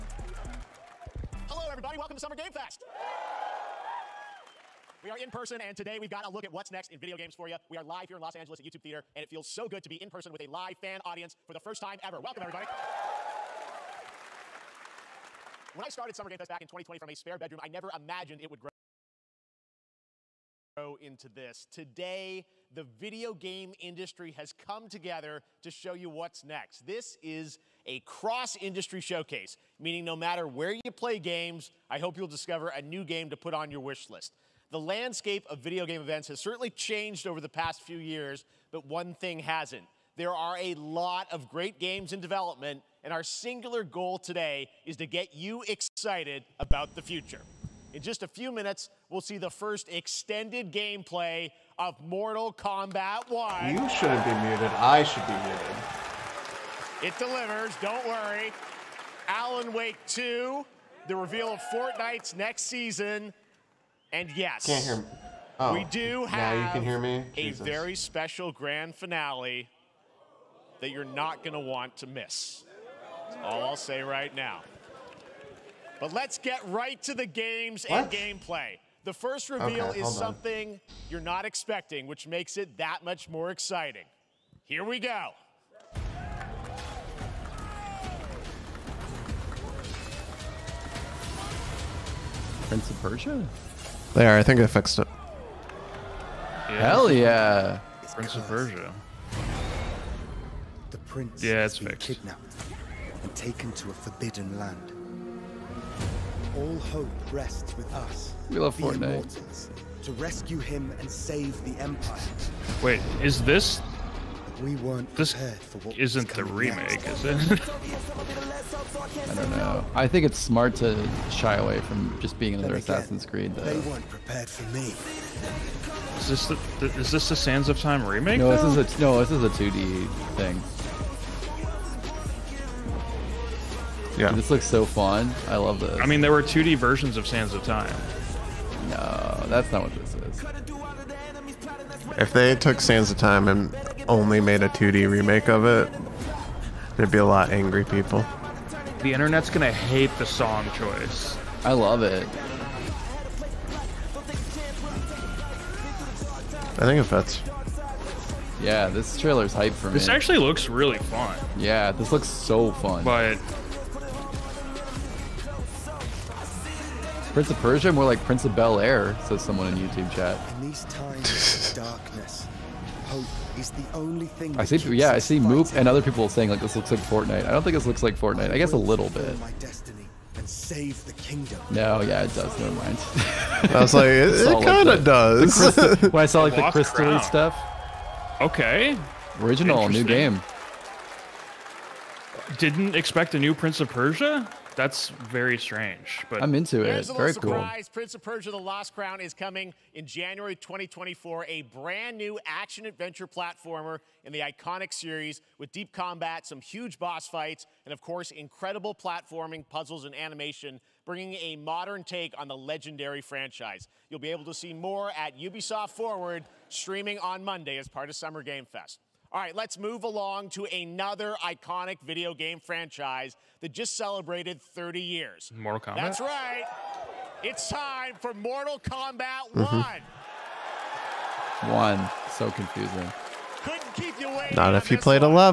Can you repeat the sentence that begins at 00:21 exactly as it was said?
Today, the video game industry has come together to show you what's next.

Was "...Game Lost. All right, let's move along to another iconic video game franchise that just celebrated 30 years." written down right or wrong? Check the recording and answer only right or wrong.
wrong.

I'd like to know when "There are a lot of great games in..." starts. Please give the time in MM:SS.
00:40.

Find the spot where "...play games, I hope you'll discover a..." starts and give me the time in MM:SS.
00:30.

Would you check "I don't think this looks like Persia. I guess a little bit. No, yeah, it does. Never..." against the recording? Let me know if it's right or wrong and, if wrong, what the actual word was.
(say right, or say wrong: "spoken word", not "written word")
wrong: "Fortnite", not "Persia".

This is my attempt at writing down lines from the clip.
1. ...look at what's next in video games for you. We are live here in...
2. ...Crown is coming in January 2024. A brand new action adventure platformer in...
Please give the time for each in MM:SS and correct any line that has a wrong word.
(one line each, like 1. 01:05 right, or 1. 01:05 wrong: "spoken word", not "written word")
1. 00:06 right
2. 03:18 right.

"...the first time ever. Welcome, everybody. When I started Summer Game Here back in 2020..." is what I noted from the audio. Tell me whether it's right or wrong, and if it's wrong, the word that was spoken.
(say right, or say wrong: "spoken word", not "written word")
wrong: "Fest", not "Here".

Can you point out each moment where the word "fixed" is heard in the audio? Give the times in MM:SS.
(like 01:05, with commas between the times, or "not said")
01:34, 01:41.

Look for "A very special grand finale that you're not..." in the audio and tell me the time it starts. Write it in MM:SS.
01:07.